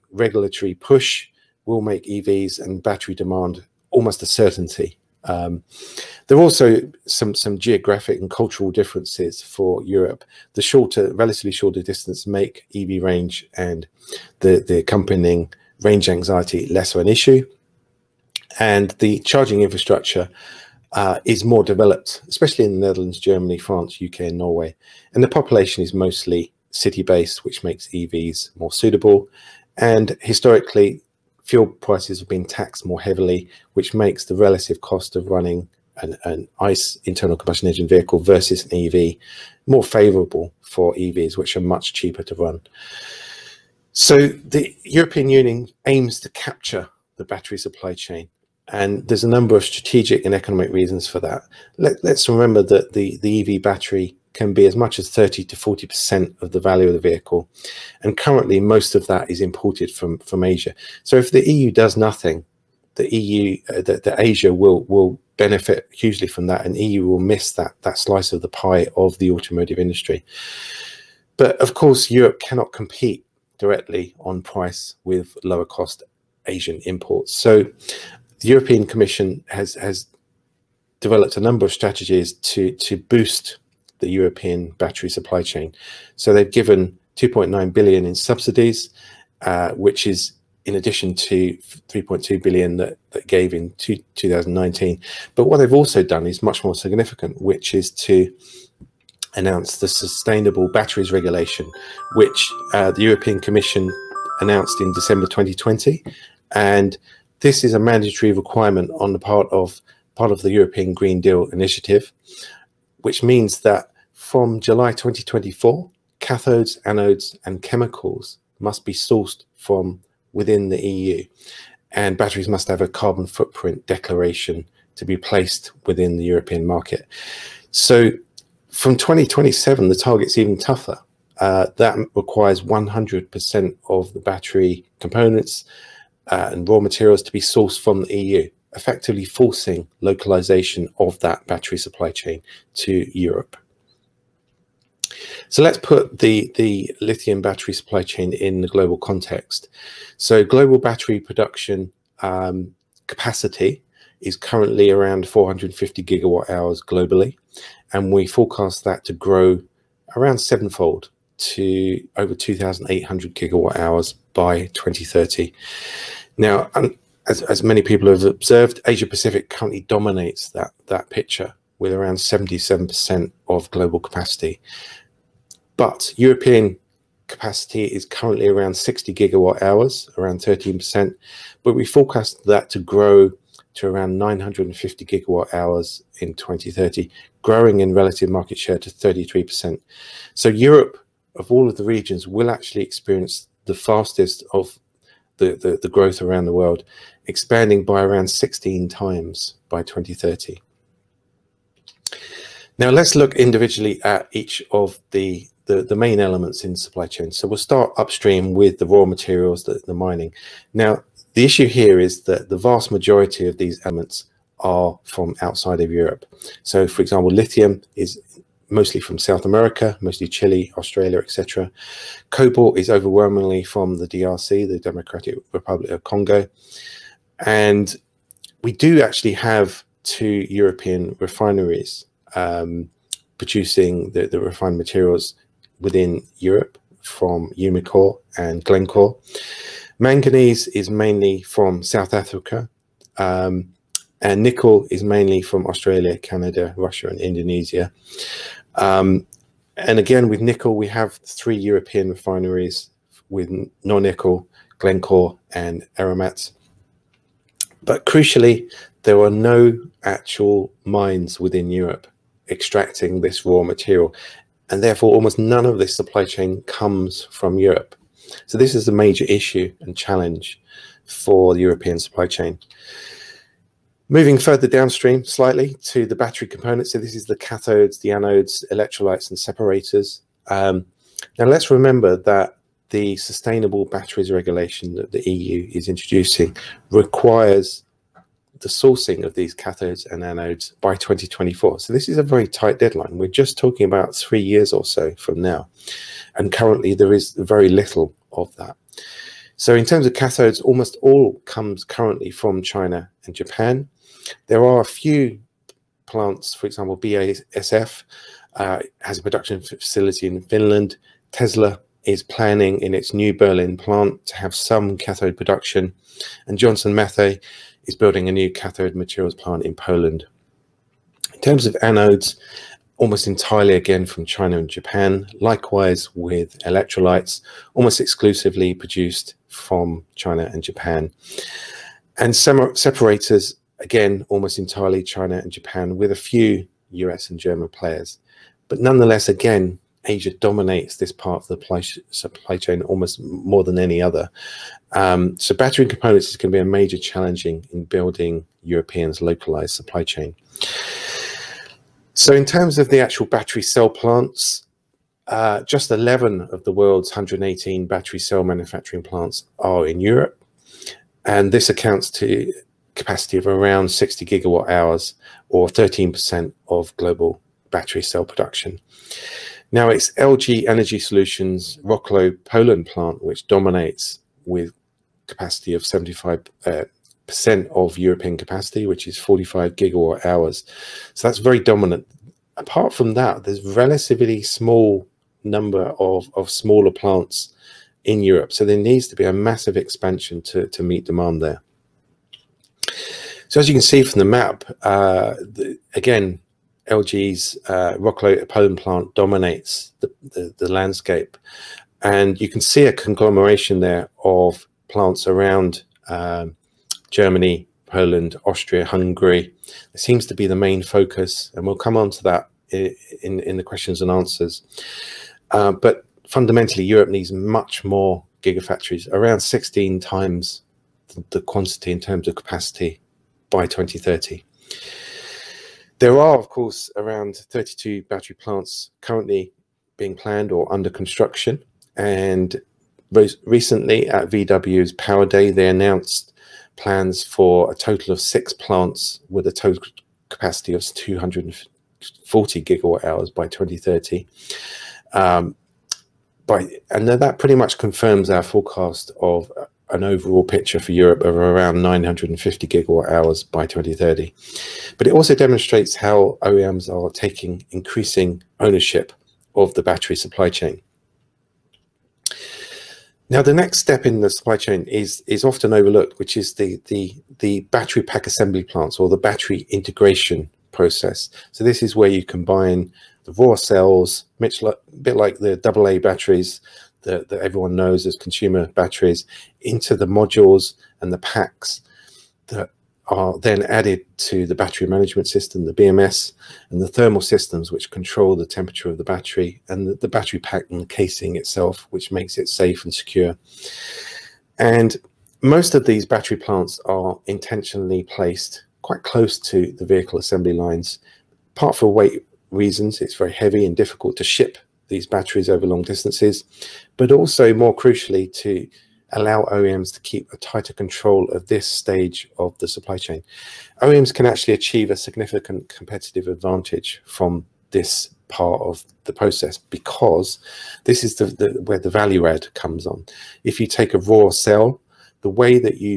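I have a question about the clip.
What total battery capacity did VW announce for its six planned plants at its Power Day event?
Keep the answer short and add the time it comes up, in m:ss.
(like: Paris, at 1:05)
240 gigawatt hours, at 7:20.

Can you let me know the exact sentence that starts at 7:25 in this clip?
Um, by, and that pretty much confirms our forecast of an overall picture for Europe of around 950 gigawatt hours by 2030.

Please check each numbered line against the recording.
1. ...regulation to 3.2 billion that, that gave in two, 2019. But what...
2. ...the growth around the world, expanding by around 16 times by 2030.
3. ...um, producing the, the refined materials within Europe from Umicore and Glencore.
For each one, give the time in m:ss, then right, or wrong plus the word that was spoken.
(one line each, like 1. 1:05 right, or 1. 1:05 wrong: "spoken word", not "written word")
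1. 1:30 wrong: "addition", not "regulation"
2. 3:15 right
3. 3:52 right.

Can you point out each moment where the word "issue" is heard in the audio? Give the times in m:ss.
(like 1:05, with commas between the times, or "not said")
0:17, 3:31, 4:29.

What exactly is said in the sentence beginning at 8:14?
And most of these battery plants are intentionally placed quite close to the vehicle assembly lines, part for weight reasons.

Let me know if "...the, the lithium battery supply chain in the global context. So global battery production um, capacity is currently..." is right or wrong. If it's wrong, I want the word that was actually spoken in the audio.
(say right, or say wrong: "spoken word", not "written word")
right.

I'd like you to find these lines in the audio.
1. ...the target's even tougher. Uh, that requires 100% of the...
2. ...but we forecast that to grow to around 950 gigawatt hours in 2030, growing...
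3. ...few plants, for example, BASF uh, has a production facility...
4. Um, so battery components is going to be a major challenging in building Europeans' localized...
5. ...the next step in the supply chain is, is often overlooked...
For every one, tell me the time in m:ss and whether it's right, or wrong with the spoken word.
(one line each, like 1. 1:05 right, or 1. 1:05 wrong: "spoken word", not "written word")
1. 2:09 right
2. 3:01 right
3. 5:04 right
4. 5:44 right
5. 7:43 right.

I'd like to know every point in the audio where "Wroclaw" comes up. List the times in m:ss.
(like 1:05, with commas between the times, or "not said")
6:11, 6:37.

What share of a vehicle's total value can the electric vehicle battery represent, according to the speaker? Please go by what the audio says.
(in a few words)
30 to 40%.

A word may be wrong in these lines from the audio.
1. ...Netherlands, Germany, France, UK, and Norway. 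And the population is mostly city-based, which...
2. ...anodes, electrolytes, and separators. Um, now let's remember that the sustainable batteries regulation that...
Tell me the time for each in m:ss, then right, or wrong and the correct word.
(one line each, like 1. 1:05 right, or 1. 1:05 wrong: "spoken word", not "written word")
1. 0:22 right
2. 4:38 right.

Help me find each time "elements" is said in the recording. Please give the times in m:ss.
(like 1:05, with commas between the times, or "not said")
3:26, 3:33.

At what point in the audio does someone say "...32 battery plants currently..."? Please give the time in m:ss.
7:07.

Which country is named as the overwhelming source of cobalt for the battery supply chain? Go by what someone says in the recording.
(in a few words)
Democratic Republic of Congo.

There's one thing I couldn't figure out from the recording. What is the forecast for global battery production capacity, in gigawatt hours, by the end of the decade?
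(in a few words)
2,800 gigawatt hours.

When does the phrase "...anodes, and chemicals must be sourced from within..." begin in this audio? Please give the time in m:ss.
1:56.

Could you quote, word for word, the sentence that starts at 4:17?
But crucially, there are no actual mines within Europe extracting this raw material.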